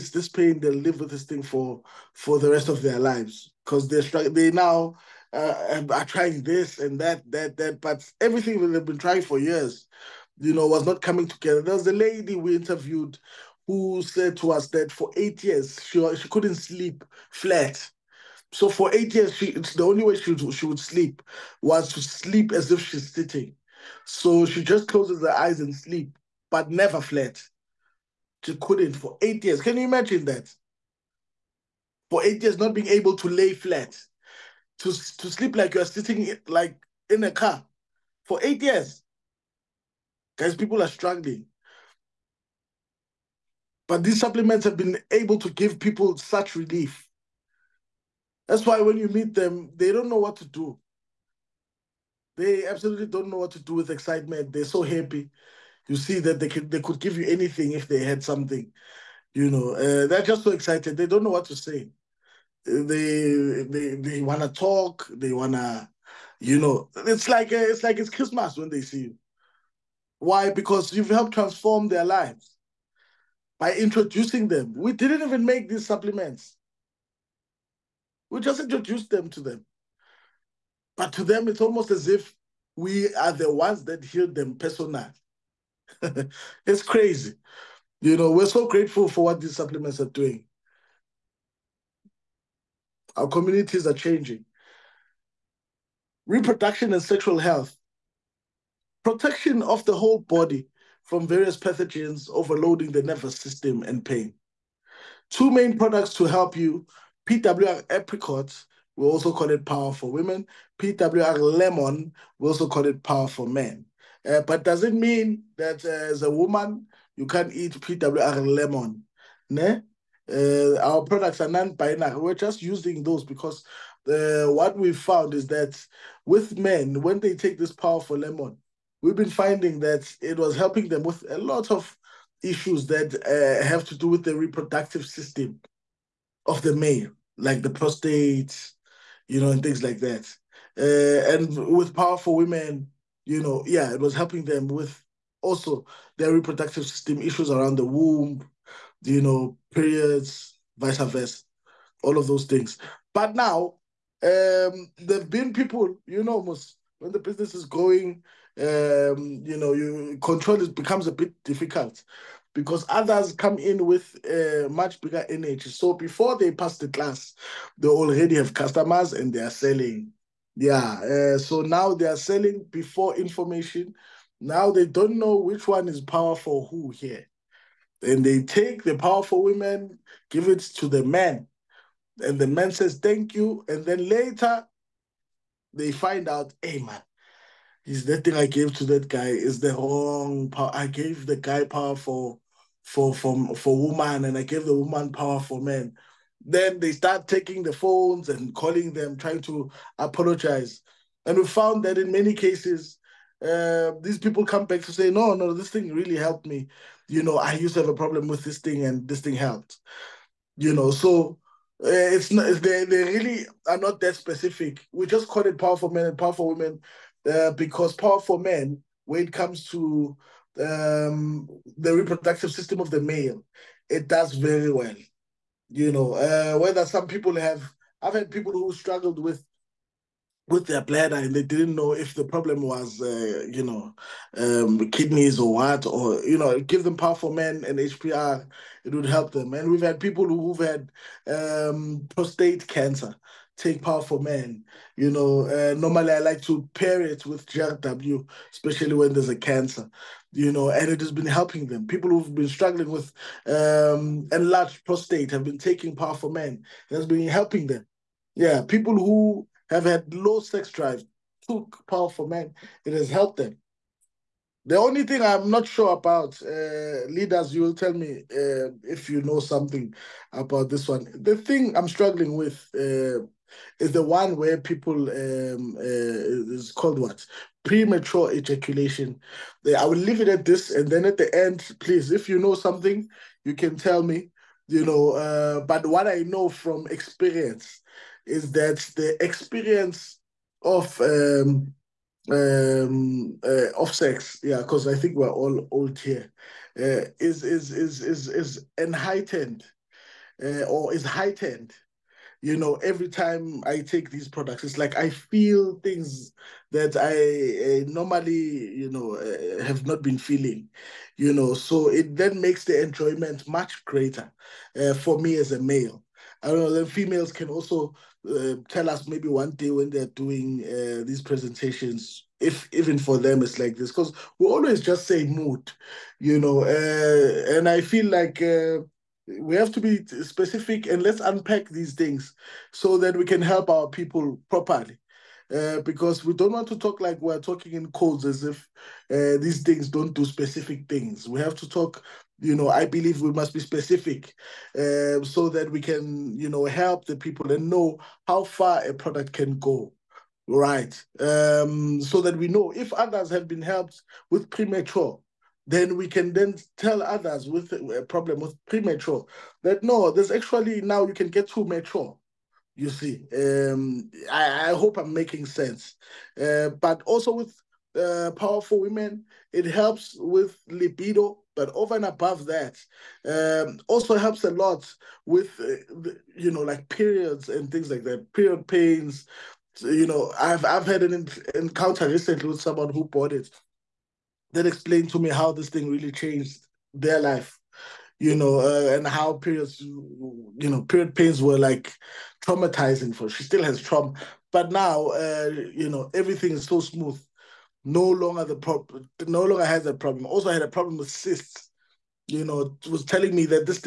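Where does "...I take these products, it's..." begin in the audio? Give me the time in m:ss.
5:03.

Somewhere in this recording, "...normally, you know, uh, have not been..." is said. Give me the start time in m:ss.
5:07.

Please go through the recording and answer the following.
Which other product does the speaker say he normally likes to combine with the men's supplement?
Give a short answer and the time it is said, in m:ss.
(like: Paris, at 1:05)
GRW, at 4:07.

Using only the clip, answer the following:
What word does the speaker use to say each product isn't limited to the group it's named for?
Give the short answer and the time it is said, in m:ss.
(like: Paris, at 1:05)
non-binary, at 2:01.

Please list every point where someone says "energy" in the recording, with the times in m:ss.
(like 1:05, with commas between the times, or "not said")
2:45.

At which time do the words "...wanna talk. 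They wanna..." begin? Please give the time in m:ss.
1:04.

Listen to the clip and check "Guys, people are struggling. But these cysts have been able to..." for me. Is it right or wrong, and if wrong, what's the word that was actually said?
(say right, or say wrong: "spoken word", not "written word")
wrong: "supplements", not "cysts".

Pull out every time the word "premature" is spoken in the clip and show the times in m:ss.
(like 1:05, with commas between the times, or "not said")
4:37, 5:54, 5:58.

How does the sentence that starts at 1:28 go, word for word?
You know, we're so grateful for what these supplements are doing.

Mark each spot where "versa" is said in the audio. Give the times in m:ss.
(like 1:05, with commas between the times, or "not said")
2:30.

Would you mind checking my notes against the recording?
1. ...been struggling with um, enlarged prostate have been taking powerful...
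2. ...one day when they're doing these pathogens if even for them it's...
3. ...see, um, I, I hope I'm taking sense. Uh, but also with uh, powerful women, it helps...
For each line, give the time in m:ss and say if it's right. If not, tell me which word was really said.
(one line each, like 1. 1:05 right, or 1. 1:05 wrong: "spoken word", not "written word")
1. 4:12 right
2. 5:19 wrong: "presentations", not "pathogens"
3. 6:02 wrong: "making", not "taking".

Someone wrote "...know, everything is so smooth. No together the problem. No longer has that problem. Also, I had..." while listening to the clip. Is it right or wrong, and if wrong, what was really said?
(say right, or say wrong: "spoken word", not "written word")
wrong: "longer", not "together".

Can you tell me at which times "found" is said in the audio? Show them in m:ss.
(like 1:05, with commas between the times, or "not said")
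2:04, 3:21.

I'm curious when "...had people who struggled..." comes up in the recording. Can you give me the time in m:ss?
3:48.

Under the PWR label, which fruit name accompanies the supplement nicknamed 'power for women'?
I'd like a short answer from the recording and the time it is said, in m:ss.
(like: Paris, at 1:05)
apricot, at 1:47.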